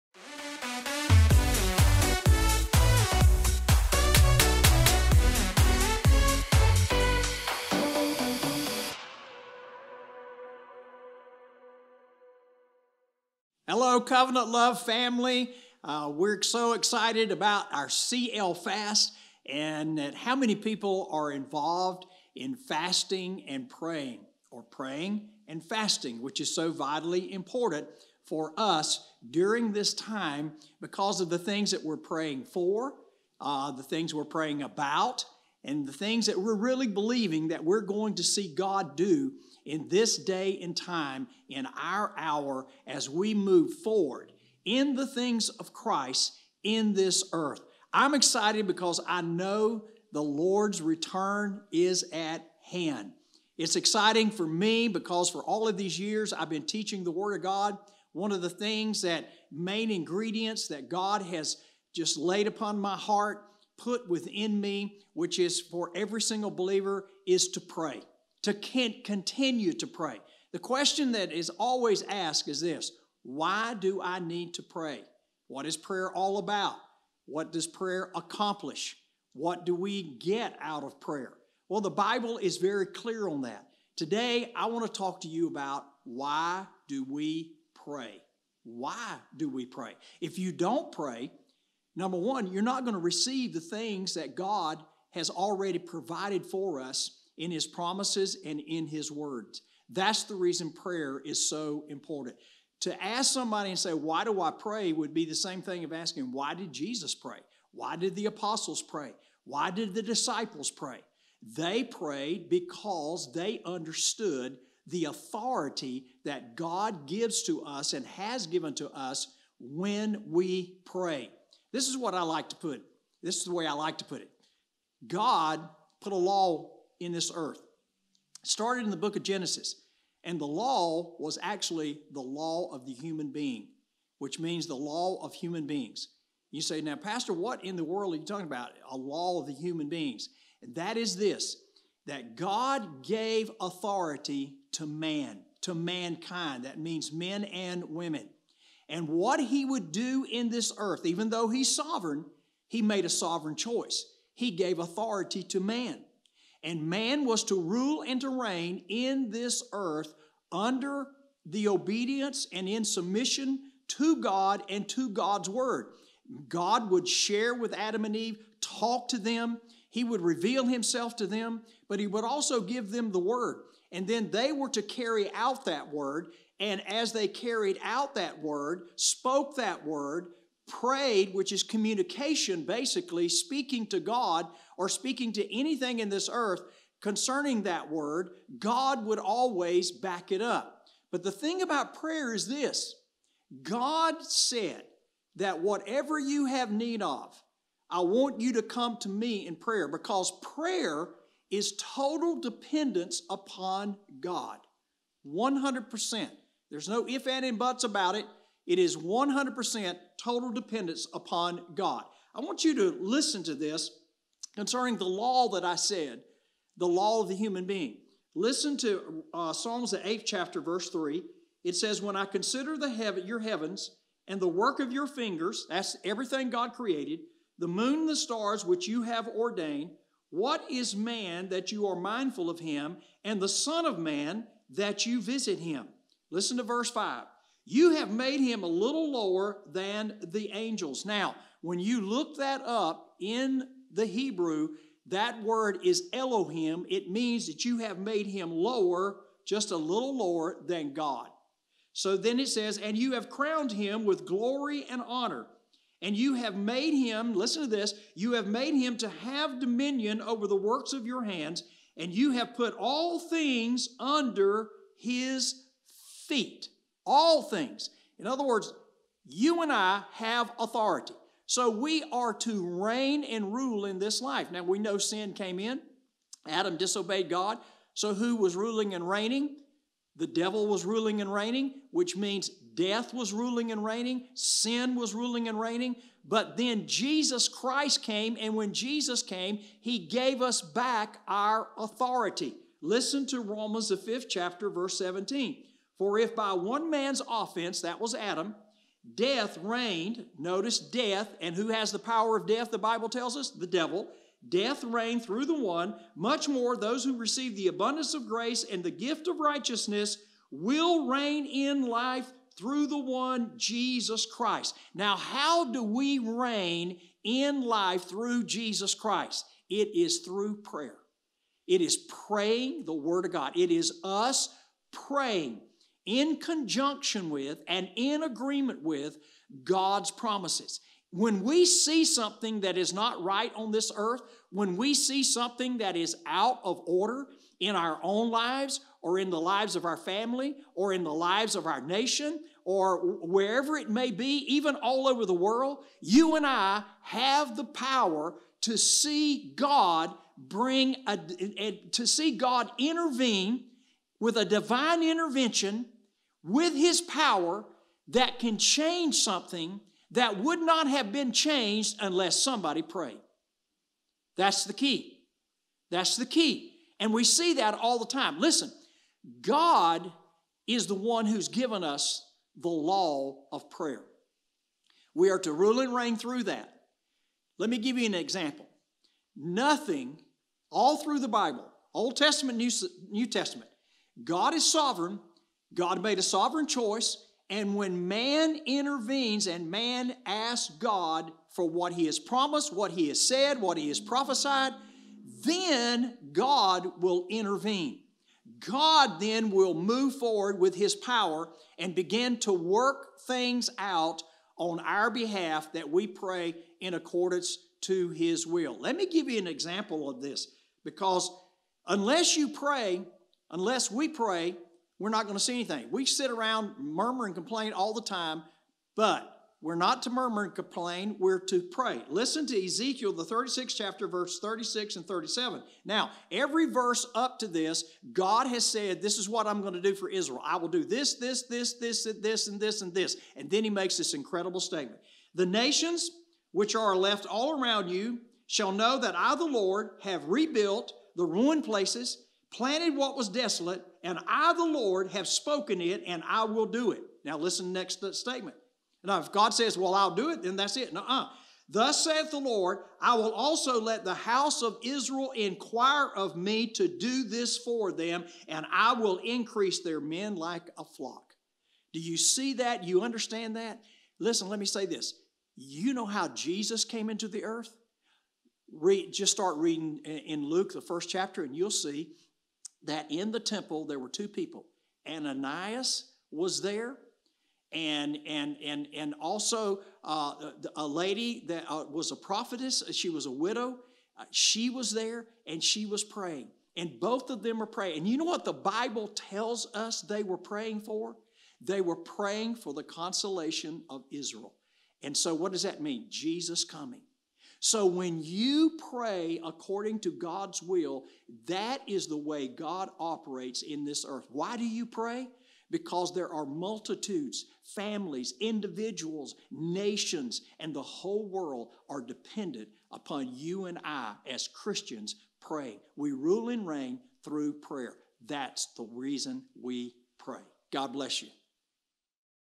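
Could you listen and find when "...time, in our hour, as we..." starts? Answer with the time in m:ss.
0:40.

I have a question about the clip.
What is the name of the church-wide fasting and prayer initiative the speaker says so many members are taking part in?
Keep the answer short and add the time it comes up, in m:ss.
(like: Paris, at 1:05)
CL Fast, at 0:17.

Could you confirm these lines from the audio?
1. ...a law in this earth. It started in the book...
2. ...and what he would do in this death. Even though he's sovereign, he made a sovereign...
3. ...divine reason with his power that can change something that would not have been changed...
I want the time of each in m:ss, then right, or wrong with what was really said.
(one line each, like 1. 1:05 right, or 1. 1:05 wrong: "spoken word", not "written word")
1. 2:06 right
2. 2:28 wrong: "earth", not "death"
3. 5:54 wrong: "intervention", not "reason".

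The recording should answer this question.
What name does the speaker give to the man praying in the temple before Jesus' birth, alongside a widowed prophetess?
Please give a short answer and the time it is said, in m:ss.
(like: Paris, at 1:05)
Ananias, at 7:55.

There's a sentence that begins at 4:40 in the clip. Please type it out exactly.
The devil was ruling and reigning, which means death was ruling and reigning, sin was ruling and reigning.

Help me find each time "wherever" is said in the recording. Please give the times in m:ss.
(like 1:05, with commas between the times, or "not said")
5:43.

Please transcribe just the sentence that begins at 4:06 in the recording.
It means that you have made him lower, just a little lower than God.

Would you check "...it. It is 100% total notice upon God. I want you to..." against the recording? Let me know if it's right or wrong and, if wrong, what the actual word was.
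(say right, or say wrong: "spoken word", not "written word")
wrong: "dependence", not "notice".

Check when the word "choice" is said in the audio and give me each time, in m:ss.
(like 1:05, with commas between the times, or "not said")
2:33, 6:26.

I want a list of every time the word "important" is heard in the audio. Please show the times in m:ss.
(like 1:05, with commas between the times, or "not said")
0:27, 1:41.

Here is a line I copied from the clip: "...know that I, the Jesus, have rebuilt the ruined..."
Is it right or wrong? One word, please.
wrong.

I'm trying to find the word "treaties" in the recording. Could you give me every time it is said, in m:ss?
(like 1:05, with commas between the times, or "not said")
not said.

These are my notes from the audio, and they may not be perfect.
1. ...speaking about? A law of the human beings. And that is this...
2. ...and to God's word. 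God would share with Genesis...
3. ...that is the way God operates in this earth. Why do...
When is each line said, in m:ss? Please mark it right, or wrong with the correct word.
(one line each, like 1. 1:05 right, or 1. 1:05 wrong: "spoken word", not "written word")
1. 2:18 wrong: "talking", not "speaking"
2. 2:44 wrong: "Adam", not "Genesis"
3. 8:21 right.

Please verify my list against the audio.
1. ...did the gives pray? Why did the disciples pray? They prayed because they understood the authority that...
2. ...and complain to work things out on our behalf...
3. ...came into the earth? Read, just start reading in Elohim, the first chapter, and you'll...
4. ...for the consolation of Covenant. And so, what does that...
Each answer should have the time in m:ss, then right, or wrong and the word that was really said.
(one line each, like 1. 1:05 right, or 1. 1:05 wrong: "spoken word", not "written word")
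1. 1:47 wrong: "apostles", not "gives"
2. 6:41 wrong: "begin", not "complain"
3. 7:46 wrong: "Luke", not "Elohim"
4. 8:12 wrong: "Israel", not "Covenant".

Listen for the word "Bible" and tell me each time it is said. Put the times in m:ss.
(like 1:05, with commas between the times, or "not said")
1:21, 5:02, 6:21, 8:08.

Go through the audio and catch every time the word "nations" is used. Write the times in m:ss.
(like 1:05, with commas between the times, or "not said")
5:41, 7:15, 8:29.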